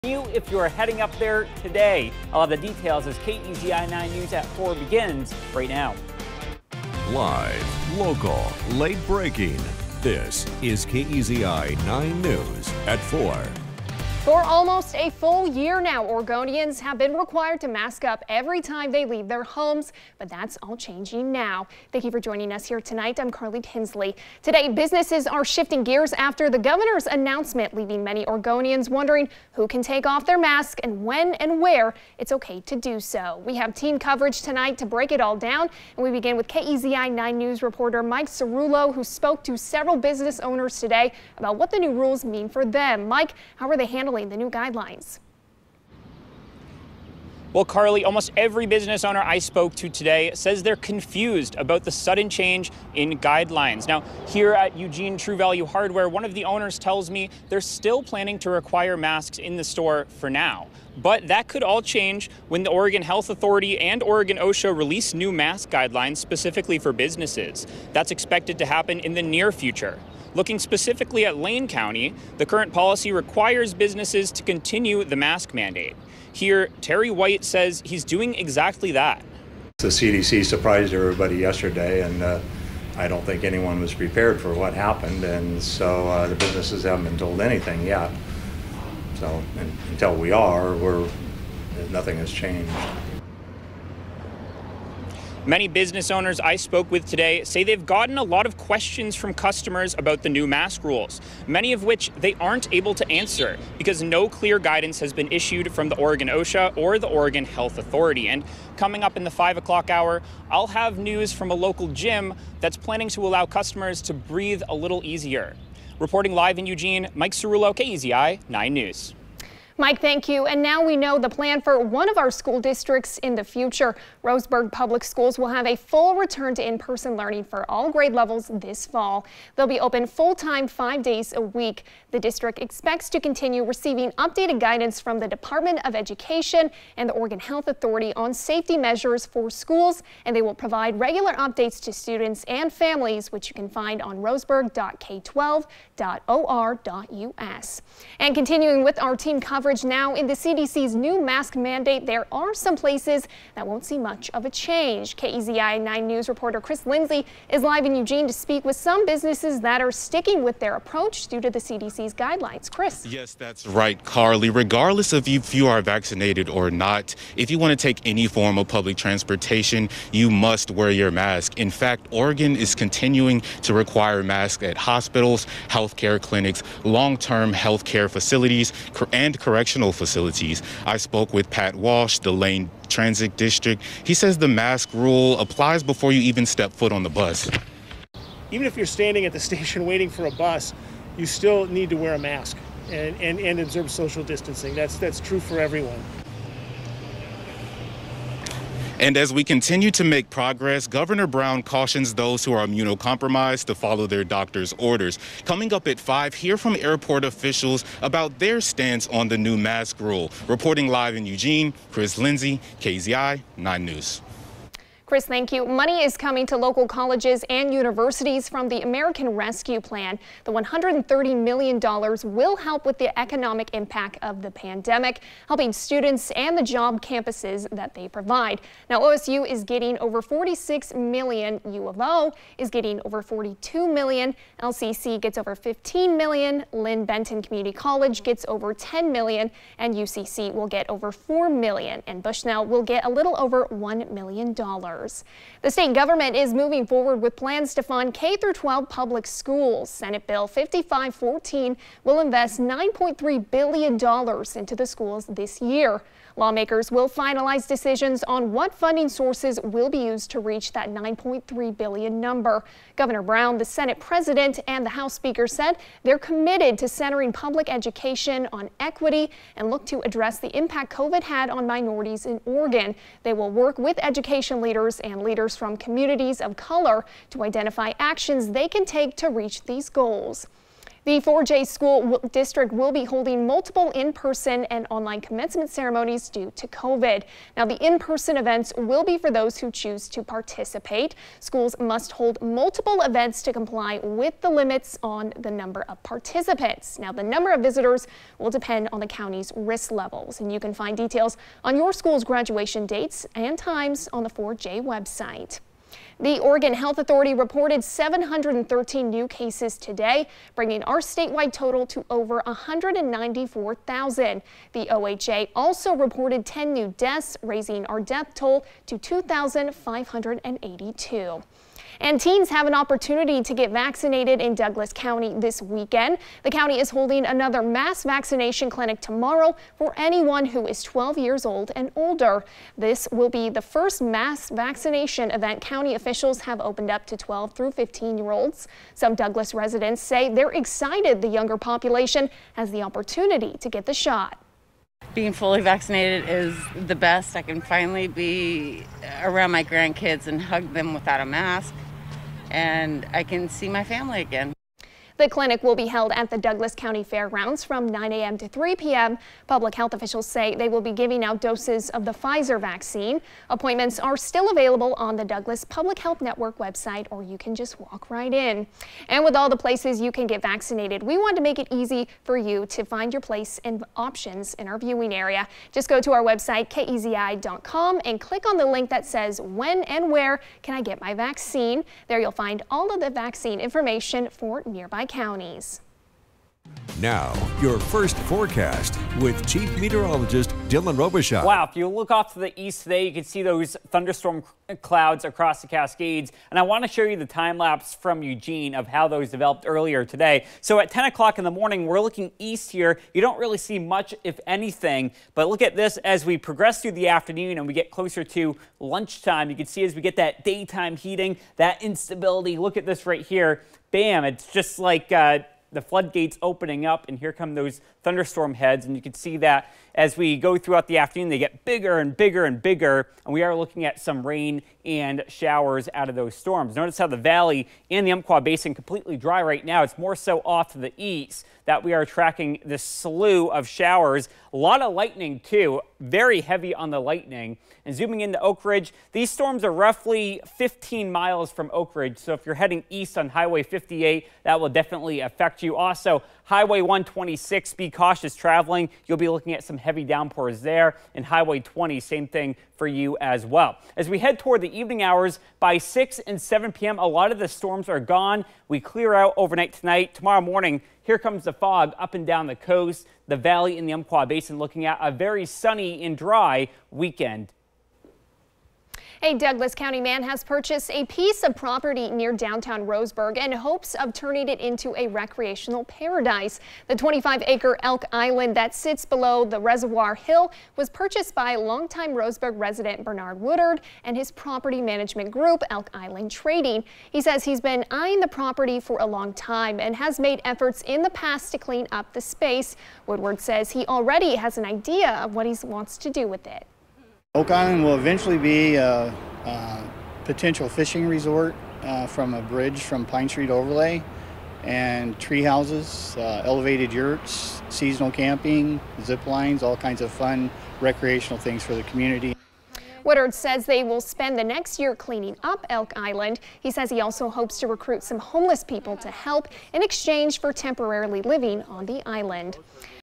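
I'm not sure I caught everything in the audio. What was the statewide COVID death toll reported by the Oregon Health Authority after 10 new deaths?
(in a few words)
2,582.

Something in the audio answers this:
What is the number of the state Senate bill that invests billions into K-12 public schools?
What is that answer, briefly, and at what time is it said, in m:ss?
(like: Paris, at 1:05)
5514, at 4:10.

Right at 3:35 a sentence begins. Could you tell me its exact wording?
Money is coming to local colleges and universities from the American Rescue Plan.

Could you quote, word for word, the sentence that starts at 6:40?
So at 10 o'clock in the morning, we're looking east here.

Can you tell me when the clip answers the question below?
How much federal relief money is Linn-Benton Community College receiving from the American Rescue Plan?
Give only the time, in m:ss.
3:58.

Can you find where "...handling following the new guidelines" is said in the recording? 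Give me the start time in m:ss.
0:43.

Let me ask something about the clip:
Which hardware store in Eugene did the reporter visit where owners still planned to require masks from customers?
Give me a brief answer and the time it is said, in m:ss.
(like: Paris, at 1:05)
Eugene True Value Hardware, at 0:54.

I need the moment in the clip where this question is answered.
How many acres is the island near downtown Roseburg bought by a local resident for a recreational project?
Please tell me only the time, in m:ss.
7:56.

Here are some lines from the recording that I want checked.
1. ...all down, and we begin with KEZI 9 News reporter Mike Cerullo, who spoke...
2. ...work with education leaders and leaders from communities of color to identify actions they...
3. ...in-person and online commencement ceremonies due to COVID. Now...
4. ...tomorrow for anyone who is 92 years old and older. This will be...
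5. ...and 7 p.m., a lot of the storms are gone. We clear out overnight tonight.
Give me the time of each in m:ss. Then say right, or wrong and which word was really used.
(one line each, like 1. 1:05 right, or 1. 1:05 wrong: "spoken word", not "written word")
1. 0:35 right
2. 4:33 right
3. 4:43 right
4. 5:29 wrong: "12", not "92"
5. 7:36 right.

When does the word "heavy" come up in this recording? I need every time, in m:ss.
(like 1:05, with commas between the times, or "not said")
7:16, 7:29.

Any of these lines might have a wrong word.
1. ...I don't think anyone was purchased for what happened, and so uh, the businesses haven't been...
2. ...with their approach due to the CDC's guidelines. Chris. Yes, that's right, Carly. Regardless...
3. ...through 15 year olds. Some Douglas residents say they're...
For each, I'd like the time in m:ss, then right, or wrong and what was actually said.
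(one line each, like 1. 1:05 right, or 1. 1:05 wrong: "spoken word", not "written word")
1. 1:22 wrong: "prepared", not "purchased"
2. 2:40 right
3. 5:37 right.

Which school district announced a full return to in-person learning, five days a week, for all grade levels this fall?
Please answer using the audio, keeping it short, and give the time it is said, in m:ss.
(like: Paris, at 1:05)
Roseburg Public Schools, at 2:04.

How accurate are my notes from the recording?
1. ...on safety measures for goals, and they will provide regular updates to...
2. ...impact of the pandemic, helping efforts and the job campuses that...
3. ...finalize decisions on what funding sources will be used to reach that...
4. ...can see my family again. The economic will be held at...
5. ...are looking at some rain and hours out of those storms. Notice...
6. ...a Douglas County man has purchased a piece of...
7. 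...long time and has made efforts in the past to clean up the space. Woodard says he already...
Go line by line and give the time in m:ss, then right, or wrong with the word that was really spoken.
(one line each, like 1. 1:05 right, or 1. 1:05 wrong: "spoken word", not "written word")
1. 2:18 wrong: "schools", not "goals"
2. 3:43 wrong: "students", not "efforts"
3. 4:17 right
4. 5:53 wrong: "clinic", not "economic"
5. 7:03 wrong: "showers", not "hours"
6. 7:49 right
7. 8:09 right.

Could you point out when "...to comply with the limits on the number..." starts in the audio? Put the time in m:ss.
4:53.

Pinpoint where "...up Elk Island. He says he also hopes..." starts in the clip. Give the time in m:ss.
8:35.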